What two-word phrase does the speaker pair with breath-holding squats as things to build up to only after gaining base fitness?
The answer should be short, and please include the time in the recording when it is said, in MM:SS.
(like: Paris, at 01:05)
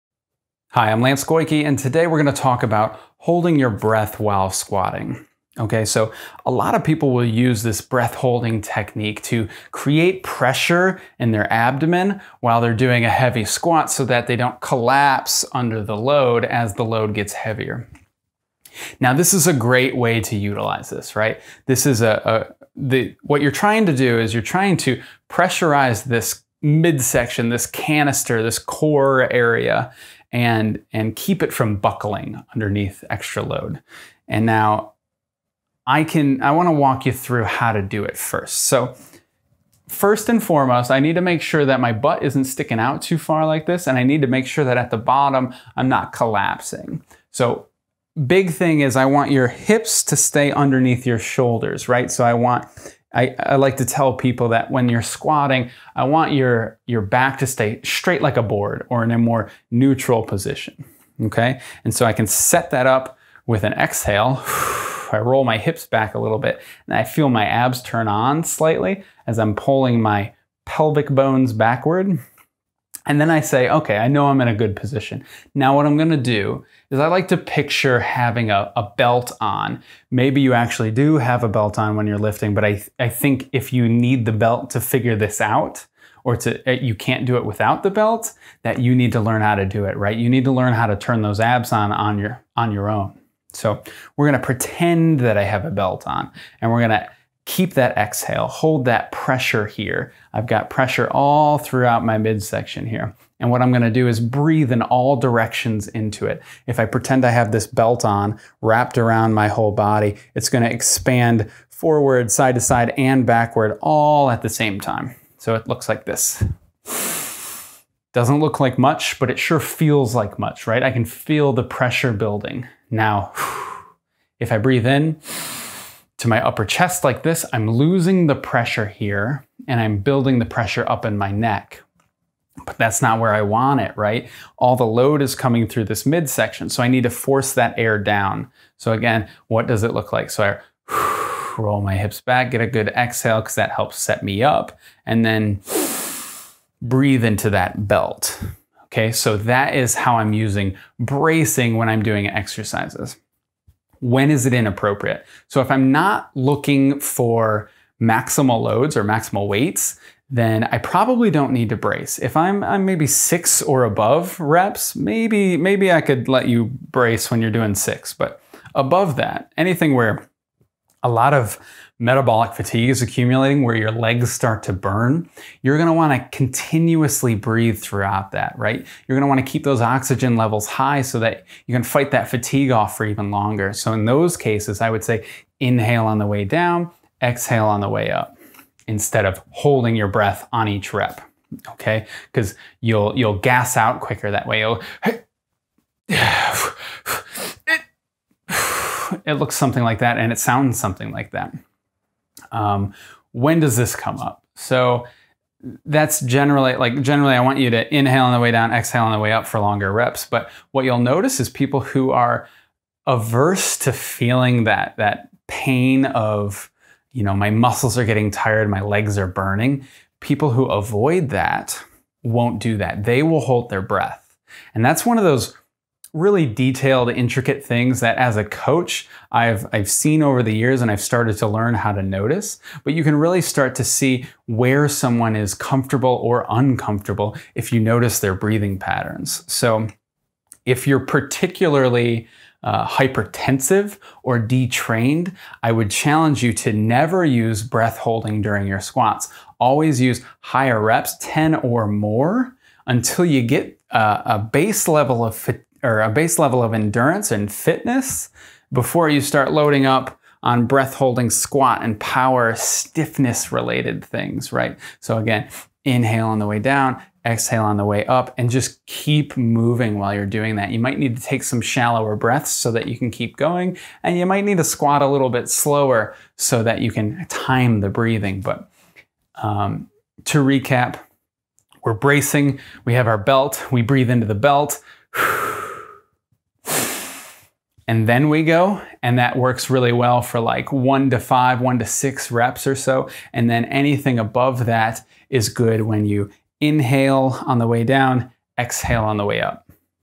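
Power stiffness, at 04:21.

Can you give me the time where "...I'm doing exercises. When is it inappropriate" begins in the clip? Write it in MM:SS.
02:31.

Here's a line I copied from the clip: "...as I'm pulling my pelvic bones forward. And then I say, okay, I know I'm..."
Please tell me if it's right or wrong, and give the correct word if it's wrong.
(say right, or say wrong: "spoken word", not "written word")
wrong: "backward", not "forward".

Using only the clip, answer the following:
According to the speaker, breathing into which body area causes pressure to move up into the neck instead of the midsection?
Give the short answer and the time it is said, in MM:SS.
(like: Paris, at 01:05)
Upper chest, at 02:06.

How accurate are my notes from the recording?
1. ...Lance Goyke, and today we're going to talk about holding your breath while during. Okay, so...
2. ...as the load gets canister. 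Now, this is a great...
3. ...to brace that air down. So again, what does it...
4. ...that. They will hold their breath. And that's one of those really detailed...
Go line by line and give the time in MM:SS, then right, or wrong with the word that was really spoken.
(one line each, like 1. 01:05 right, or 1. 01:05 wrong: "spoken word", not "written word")
1. 00:01 wrong: "squatting", not "during"
2. 00:16 wrong: "heavier", not "canister"
3. 02:17 wrong: "force", not "brace"
4. 03:42 right.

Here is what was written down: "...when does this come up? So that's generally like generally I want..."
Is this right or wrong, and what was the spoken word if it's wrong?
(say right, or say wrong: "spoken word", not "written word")
right.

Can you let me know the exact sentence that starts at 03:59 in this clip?
So if you're particularly uh, hypertensive or detrained, I would challenge you to never use breath holding during your squats.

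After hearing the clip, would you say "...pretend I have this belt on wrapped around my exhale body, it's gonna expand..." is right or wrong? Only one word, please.
wrong.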